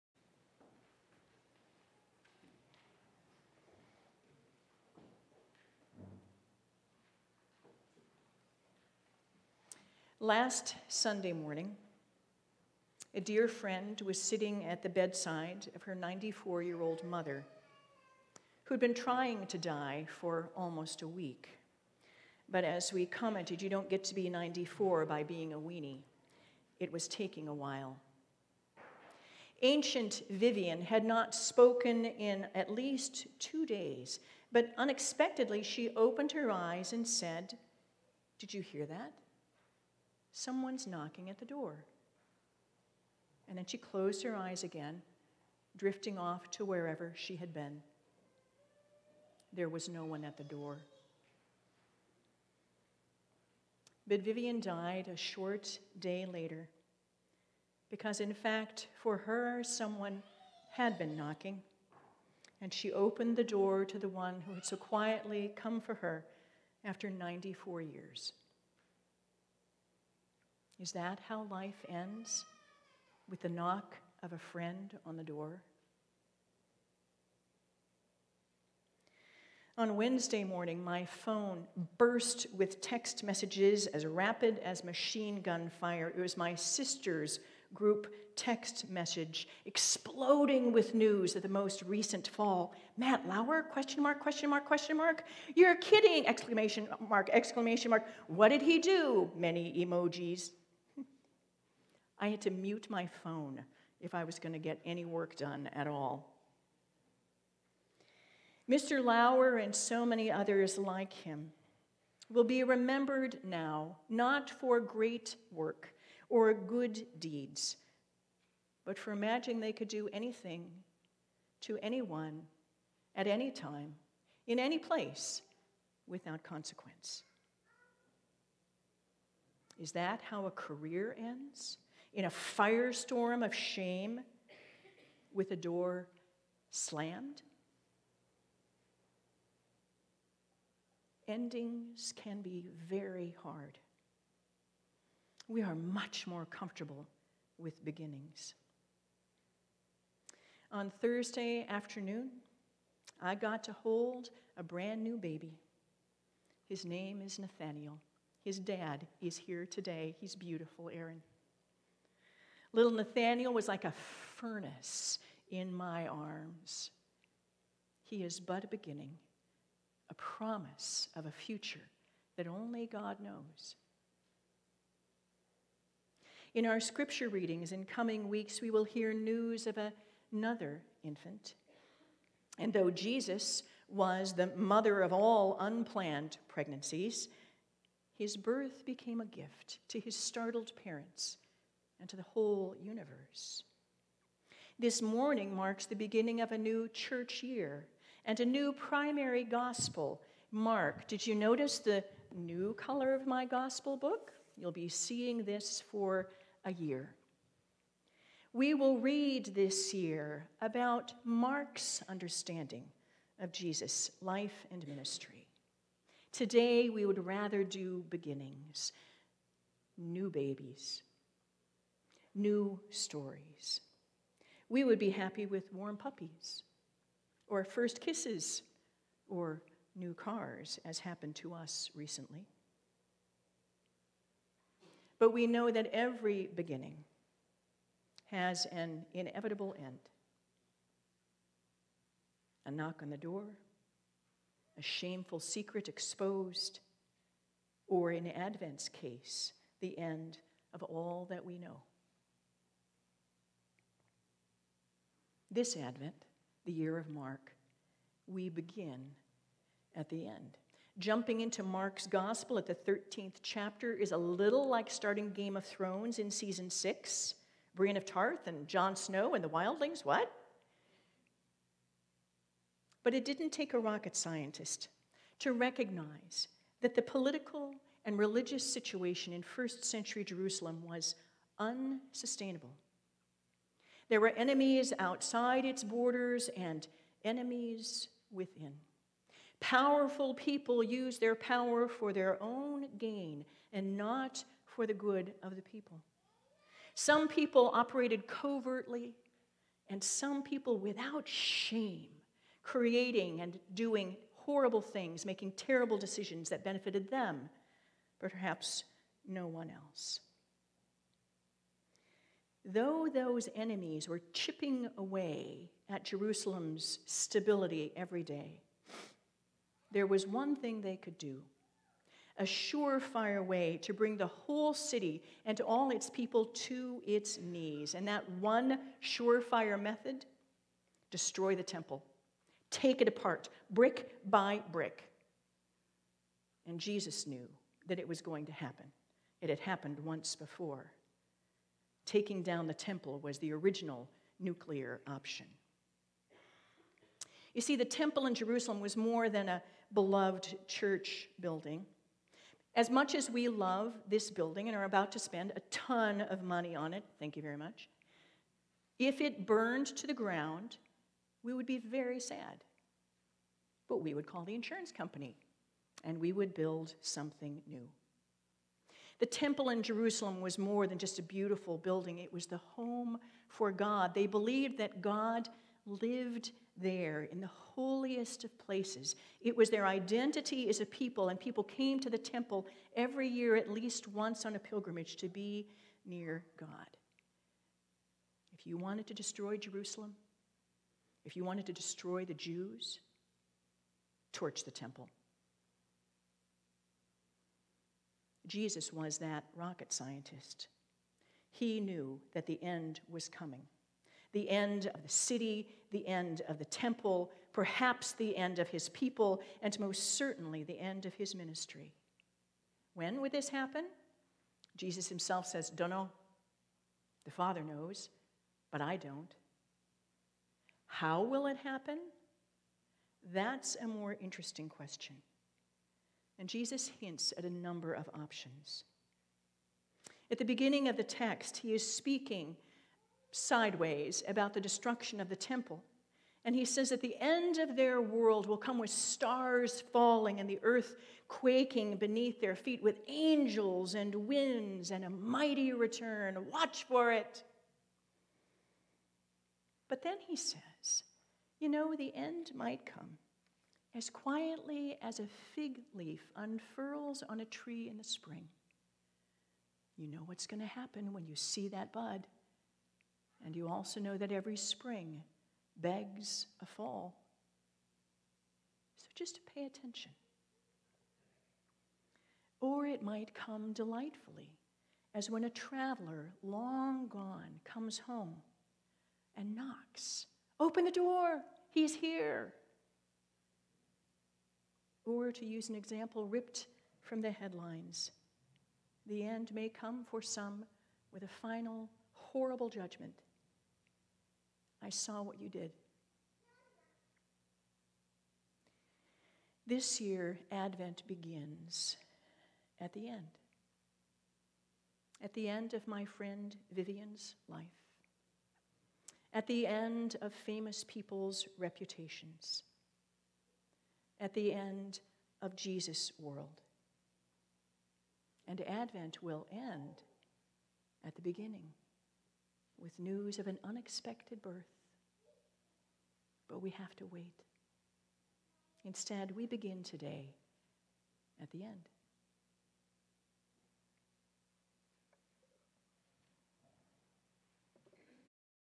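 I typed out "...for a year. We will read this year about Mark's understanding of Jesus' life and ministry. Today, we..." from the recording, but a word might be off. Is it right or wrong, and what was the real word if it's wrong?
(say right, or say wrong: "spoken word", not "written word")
right.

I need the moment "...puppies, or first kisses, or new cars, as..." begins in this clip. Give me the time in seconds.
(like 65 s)
225 s.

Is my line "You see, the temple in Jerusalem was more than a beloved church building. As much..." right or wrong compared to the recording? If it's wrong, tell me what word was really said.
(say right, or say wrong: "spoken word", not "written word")
right.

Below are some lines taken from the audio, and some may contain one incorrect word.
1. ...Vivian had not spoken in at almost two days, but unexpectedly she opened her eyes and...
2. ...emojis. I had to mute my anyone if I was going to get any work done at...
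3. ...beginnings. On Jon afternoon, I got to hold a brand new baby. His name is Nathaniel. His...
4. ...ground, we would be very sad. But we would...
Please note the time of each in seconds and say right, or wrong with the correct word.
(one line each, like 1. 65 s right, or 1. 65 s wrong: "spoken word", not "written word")
1. 30 s wrong: "least", not "almost"
2. 99 s wrong: "phone", not "anyone"
3. 147 s wrong: "Thursday", not "Jon"
4. 360 s right.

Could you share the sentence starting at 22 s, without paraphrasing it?
But as we commented, you don't get to be 94 by being a weenie.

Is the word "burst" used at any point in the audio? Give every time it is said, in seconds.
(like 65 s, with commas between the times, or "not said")
81 s.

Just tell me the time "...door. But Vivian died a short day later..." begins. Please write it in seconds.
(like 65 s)
50 s.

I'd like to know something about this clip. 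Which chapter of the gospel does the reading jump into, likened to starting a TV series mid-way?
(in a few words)
13th chapter.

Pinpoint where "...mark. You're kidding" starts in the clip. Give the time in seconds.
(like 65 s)
94 s.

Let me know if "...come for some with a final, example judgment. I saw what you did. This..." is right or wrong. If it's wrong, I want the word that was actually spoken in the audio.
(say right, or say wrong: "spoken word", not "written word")
wrong: "horrible", not "example".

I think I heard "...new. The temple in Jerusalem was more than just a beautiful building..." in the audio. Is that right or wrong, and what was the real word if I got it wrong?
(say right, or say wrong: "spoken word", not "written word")
right.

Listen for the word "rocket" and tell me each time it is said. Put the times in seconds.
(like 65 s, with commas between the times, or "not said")
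273 s, 399 s.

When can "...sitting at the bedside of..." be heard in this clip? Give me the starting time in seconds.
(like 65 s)
14 s.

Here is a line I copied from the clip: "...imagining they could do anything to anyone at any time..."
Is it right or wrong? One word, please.
right.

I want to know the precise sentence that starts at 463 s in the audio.
And you also know that every spring begs a fall.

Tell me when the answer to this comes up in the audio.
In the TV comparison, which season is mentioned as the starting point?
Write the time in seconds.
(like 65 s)
266 s.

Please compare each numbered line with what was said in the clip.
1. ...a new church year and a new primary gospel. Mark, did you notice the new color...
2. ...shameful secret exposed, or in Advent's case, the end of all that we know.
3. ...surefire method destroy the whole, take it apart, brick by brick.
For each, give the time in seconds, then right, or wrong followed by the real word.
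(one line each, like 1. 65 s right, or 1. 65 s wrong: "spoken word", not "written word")
1. 196 s right
2. 244 s right
3. 329 s wrong: "temple", not "whole".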